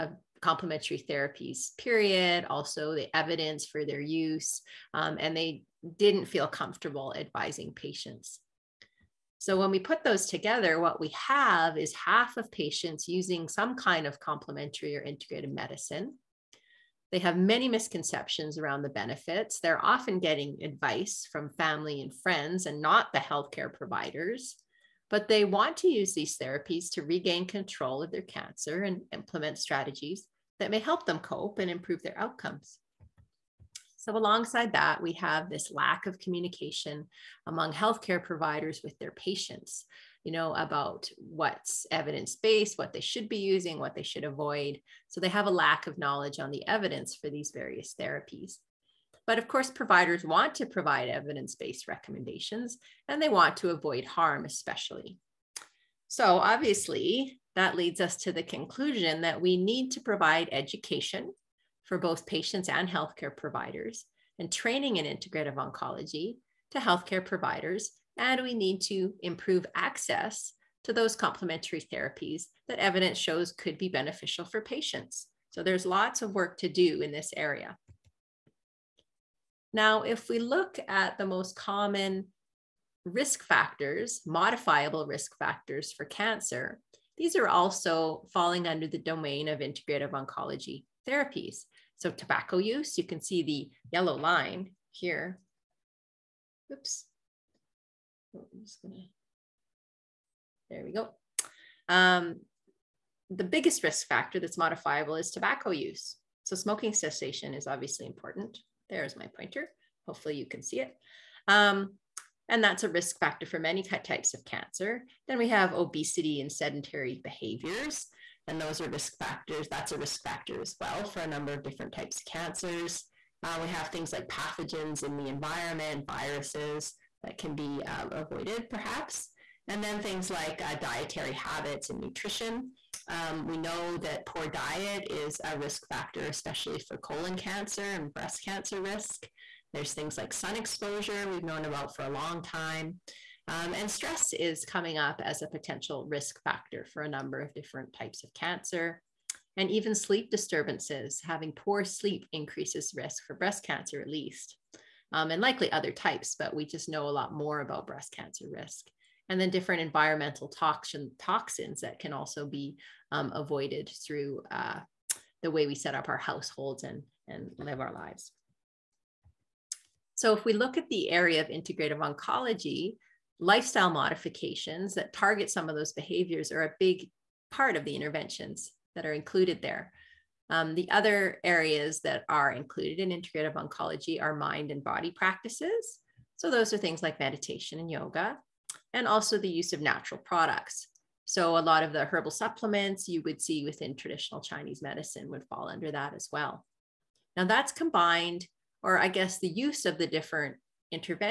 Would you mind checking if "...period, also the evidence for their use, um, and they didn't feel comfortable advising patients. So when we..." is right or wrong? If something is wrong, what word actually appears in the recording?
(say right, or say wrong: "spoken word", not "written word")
right.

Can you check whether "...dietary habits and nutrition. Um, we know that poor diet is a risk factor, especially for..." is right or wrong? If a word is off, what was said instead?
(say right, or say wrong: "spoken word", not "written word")
right.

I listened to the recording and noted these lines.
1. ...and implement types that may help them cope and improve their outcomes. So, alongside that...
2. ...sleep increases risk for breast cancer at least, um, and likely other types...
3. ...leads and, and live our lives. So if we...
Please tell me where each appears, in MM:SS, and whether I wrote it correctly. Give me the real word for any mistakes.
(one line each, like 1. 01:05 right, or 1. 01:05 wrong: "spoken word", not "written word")
1. 00:28 wrong: "strategies", not "types"
2. 02:31 right
3. 02:46 wrong: "households", not "leads".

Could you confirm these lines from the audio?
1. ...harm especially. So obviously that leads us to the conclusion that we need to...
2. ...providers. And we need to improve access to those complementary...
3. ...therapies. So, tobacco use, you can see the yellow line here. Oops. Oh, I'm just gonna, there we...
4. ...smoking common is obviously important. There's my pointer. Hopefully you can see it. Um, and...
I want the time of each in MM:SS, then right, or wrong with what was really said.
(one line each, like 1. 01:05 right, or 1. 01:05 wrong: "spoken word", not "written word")
1. 00:54 right
2. 01:07 right
3. 01:31 right
4. 01:46 wrong: "cessation", not "common".